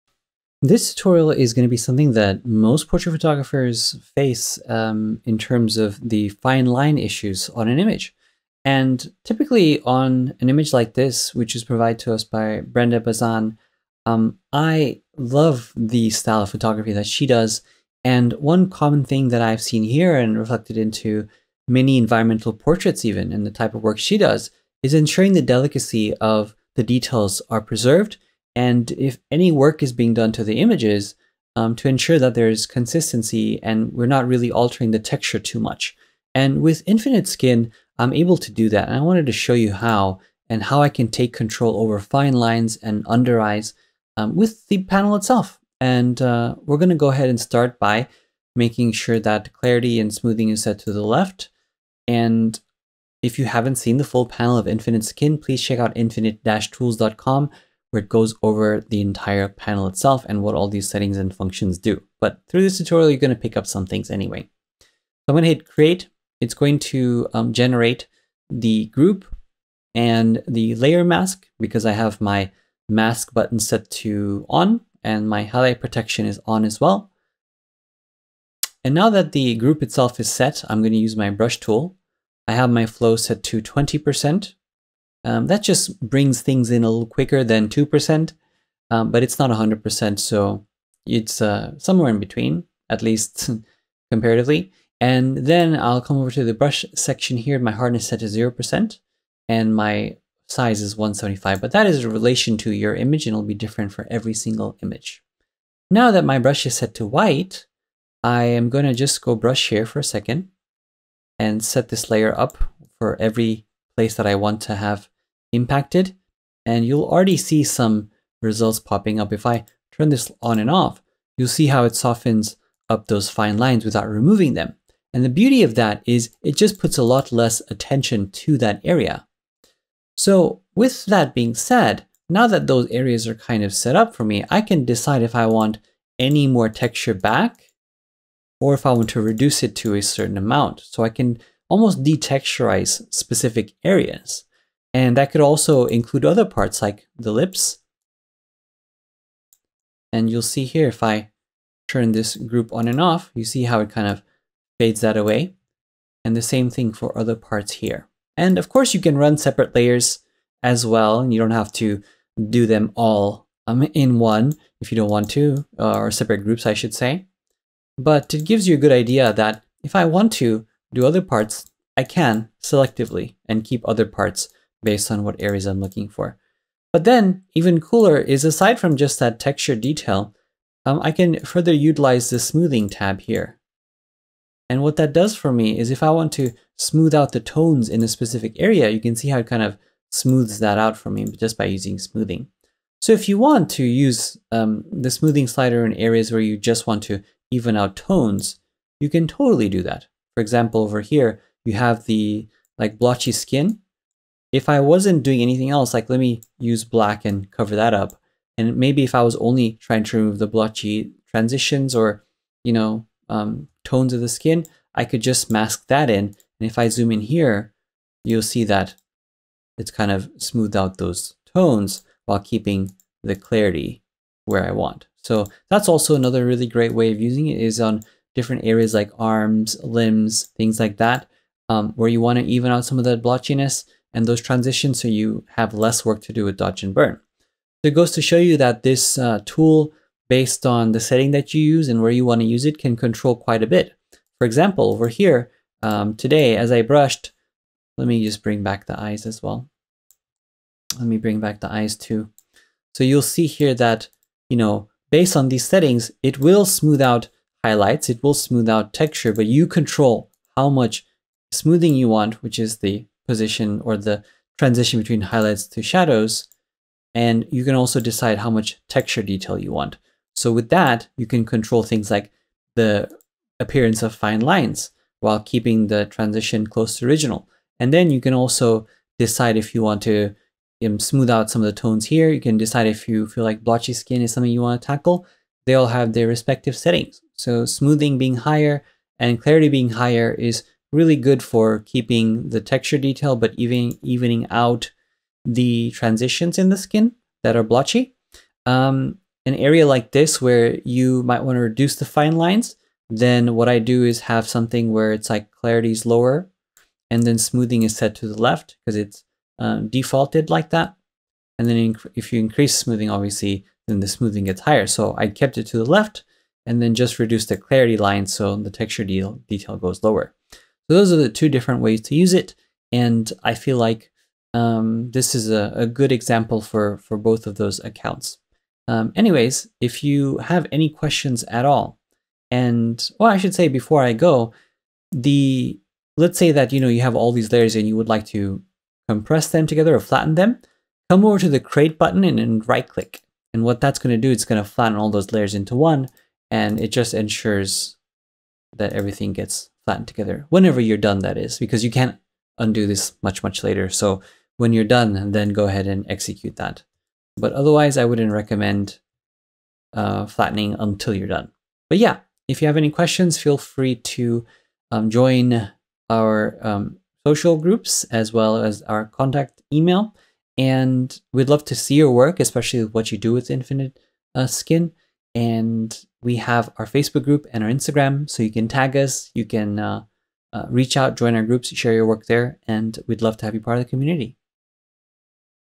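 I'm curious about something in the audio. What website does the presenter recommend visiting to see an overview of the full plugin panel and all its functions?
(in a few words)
infinite-tools.com.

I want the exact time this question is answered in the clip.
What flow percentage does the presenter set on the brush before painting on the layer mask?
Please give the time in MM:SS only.
01:23.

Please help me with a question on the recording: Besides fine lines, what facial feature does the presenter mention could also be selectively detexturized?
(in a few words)
the lips.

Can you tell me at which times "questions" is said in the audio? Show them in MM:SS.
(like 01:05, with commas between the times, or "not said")
05:30, 06:02.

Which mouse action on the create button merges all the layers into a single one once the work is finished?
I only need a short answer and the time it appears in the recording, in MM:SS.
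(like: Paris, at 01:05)
right click, at 05:42.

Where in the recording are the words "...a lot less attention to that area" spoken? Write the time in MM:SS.
02:06.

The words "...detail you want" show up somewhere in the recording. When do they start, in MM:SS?
04:29.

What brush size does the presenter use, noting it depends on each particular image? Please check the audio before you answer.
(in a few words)
175.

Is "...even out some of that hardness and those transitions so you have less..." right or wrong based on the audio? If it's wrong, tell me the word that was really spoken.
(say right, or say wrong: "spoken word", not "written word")
wrong: "blotchiness", not "hardness".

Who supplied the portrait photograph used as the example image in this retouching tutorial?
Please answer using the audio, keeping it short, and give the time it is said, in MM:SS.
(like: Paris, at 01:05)
Brenda Bazan, at 00:12.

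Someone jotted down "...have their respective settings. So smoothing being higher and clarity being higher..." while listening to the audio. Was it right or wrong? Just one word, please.
right.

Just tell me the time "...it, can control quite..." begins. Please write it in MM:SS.
04:02.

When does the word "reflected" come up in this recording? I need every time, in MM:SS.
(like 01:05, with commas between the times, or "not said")
00:20.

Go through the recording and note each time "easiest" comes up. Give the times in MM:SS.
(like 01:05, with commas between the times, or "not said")
not said.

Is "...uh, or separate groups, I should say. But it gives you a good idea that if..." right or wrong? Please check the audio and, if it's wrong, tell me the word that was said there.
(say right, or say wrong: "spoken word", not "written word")
right.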